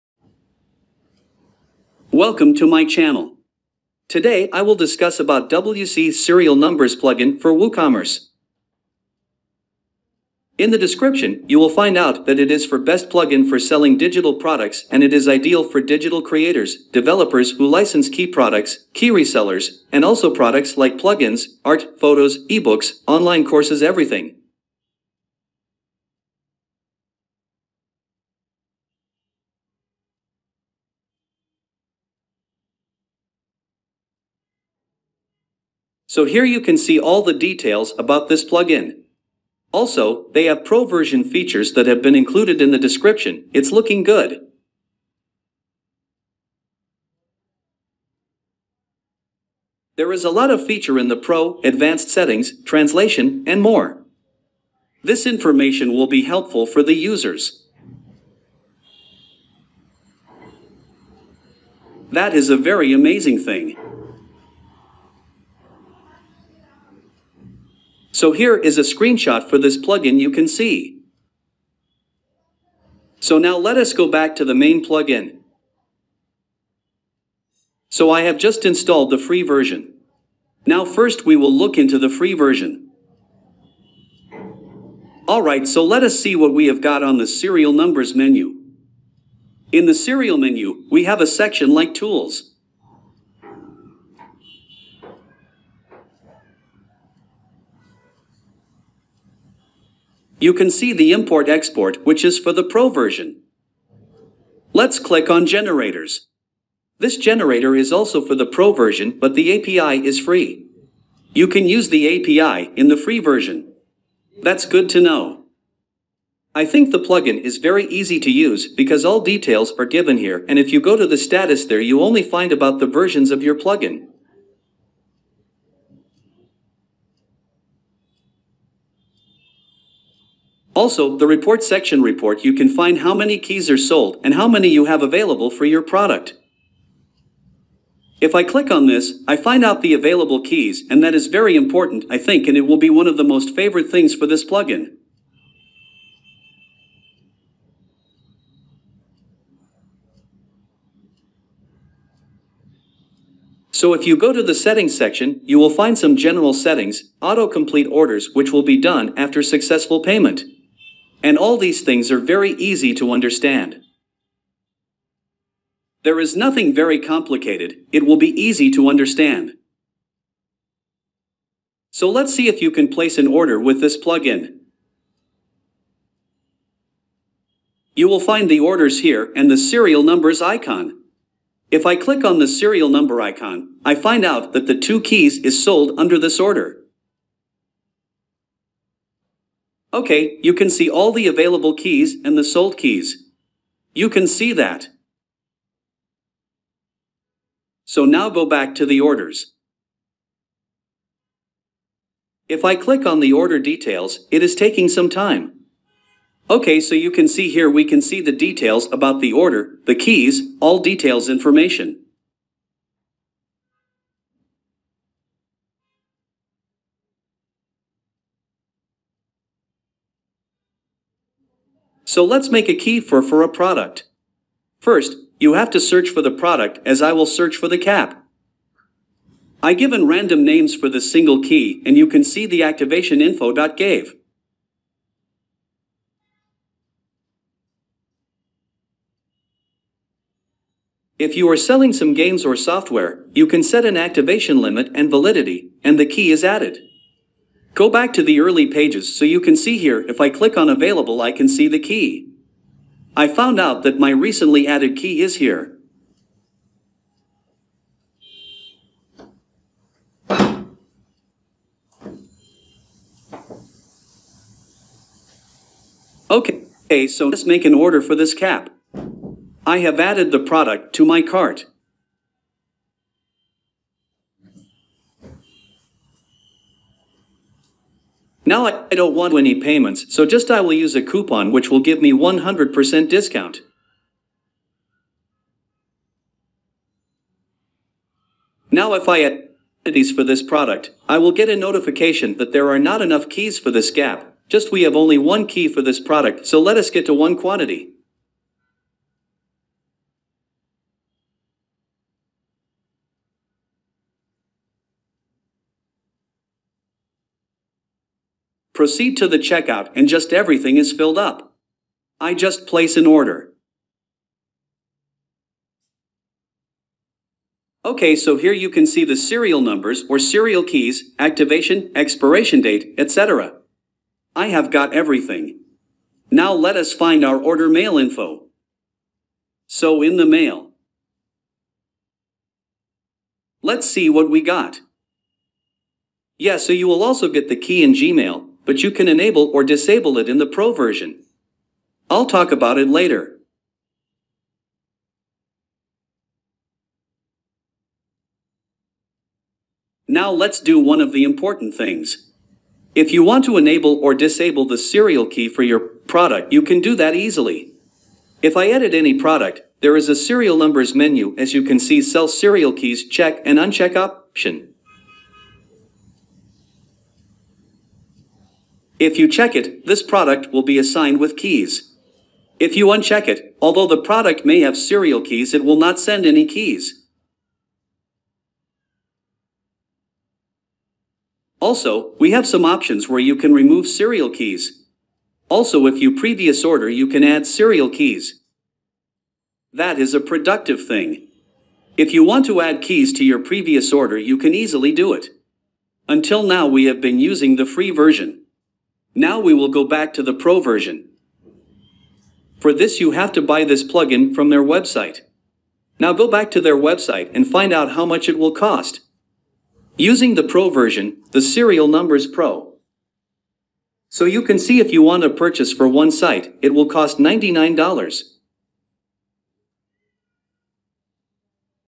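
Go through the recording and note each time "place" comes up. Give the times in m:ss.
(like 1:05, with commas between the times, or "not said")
2:52, 5:12.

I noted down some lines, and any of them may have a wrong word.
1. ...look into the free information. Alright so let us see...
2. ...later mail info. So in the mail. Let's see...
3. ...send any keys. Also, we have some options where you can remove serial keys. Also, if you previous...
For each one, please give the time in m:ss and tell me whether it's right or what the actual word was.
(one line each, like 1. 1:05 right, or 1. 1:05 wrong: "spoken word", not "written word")
1. 1:21 wrong: "version", not "information"
2. 5:27 wrong: "order", not "later"
3. 6:15 right.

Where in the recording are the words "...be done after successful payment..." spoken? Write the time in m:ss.
2:38.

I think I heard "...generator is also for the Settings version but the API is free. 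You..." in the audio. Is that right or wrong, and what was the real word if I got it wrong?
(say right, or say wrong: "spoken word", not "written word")
wrong: "Pro", not "Settings".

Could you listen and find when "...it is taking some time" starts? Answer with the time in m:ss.
3:24.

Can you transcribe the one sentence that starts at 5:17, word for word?
Okay, so here you can see the serial numbers or serial keys, activation, expiration date, etc.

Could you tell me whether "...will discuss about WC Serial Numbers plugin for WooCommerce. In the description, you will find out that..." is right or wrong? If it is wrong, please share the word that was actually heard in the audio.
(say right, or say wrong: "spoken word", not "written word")
right.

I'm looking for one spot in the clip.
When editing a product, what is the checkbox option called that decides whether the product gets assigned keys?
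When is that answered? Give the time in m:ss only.
6:02.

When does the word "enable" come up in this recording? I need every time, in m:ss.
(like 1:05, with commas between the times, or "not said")
5:39, 5:53.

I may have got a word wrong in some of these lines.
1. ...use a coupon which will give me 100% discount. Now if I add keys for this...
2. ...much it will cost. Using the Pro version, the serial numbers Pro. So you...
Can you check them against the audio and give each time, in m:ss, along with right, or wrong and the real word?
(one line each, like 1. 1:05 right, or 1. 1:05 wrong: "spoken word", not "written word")
1. 4:40 right
2. 6:48 right.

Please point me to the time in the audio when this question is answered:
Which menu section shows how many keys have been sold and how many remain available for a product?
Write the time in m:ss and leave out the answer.
2:11.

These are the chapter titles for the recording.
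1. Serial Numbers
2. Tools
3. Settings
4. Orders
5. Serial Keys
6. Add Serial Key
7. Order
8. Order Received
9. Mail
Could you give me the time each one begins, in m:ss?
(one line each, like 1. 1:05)
1. 1:20
2. 1:40
3. 2:35
4. 3:00
5. 3:15
6. 3:45
7. 4:25
8. 5:10
9. 5:25.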